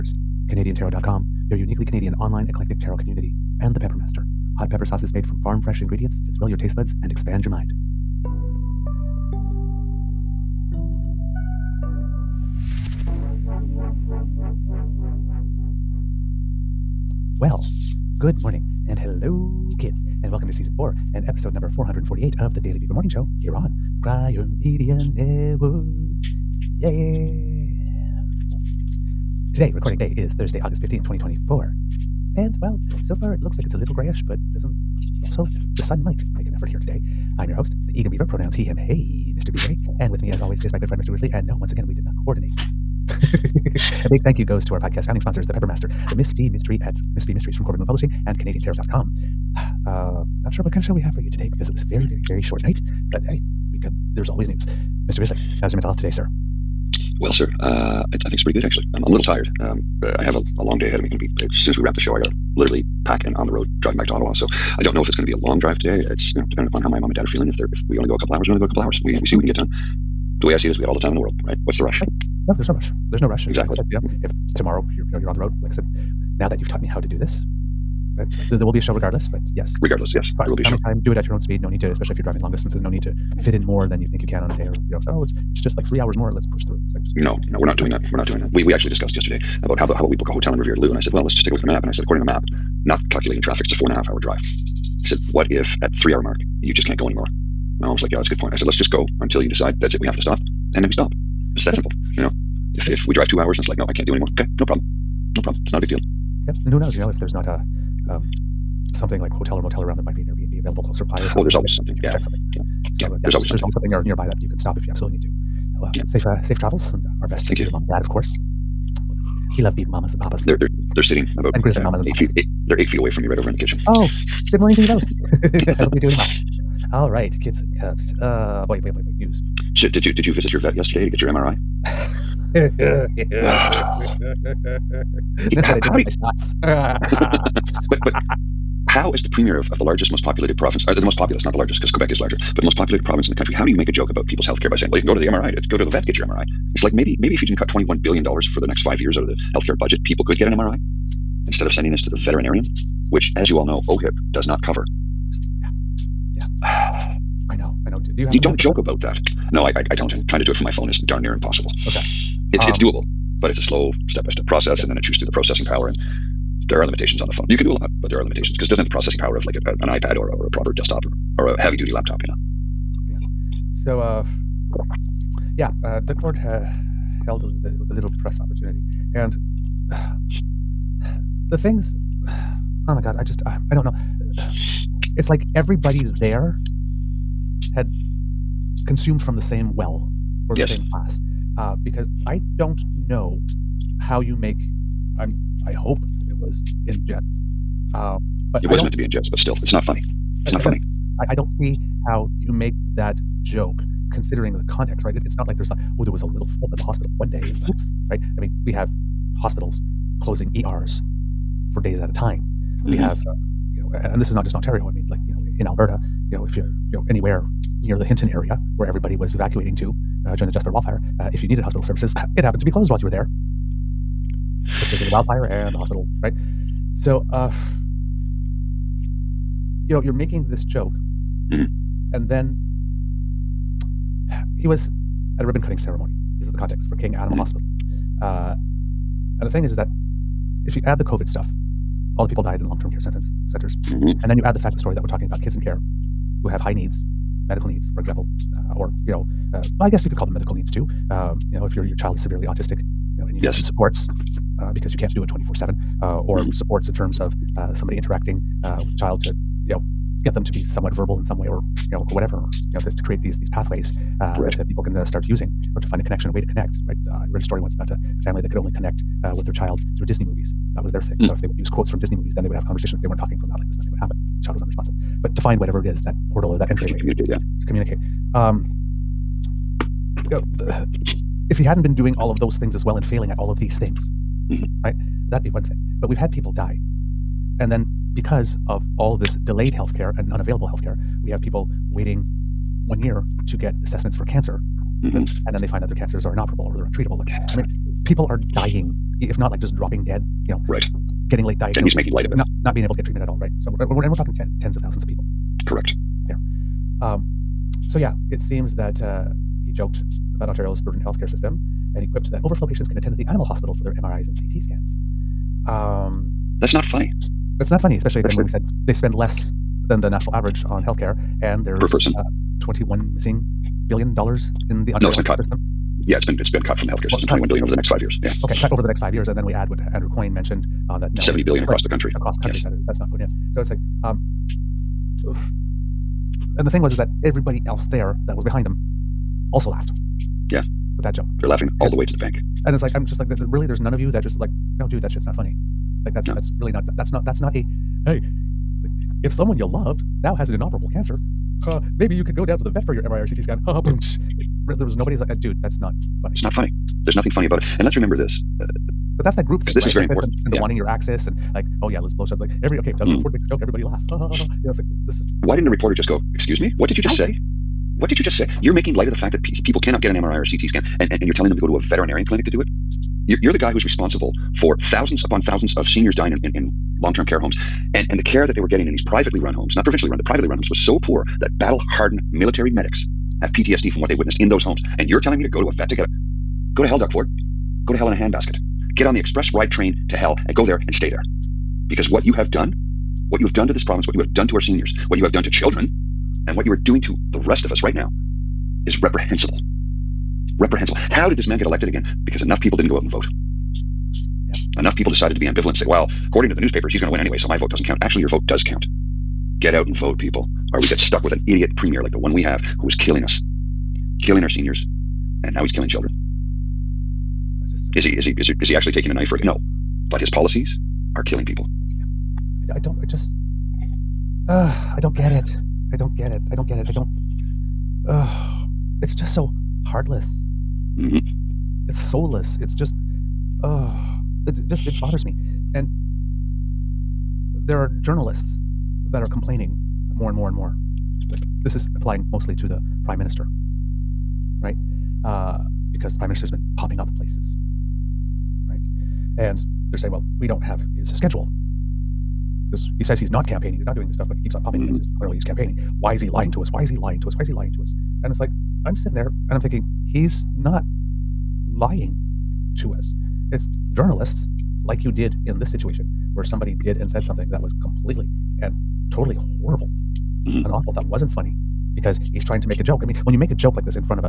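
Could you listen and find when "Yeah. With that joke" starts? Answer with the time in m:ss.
5:40.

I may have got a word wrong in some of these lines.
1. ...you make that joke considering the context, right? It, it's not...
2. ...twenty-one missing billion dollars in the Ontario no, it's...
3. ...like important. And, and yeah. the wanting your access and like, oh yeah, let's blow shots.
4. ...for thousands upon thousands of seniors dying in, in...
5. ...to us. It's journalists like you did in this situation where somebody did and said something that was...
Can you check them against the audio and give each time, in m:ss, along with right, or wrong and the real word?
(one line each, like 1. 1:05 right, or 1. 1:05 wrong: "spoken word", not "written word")
1. 3:22 right
2. 5:22 right
3. 6:00 right
4. 6:14 right
5. 7:42 right.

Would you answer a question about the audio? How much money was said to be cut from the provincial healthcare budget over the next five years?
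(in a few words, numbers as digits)
21 billion dollars.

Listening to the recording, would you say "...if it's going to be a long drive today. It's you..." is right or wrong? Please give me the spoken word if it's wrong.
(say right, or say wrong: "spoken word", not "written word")
right.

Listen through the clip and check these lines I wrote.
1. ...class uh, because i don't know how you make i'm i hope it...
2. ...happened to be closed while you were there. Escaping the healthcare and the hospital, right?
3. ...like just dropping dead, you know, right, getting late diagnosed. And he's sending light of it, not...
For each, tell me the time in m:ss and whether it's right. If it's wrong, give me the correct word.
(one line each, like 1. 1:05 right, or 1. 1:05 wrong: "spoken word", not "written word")
1. 3:10 right
2. 3:42 wrong: "wildfire", not "healthcare"
3. 4:59 wrong: "making", not "sending".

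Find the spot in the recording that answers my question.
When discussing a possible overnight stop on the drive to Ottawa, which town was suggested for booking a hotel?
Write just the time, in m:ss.
1:30.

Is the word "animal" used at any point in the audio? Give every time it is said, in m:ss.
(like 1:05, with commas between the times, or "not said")
3:57, 5:13.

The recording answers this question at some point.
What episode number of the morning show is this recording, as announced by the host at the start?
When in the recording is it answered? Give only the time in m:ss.
0:21.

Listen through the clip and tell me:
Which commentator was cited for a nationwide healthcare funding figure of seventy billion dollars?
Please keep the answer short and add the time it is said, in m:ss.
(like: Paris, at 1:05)
Andrew Coyne, at 5:29.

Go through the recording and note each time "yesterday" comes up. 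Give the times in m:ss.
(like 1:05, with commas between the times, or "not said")
1:29, 2:10.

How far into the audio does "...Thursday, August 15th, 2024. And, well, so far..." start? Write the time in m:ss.
0:30.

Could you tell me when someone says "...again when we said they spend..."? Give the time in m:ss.
5:18.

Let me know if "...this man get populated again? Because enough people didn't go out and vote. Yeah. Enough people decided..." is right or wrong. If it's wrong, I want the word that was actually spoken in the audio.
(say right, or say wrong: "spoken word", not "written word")
wrong: "elected", not "populated".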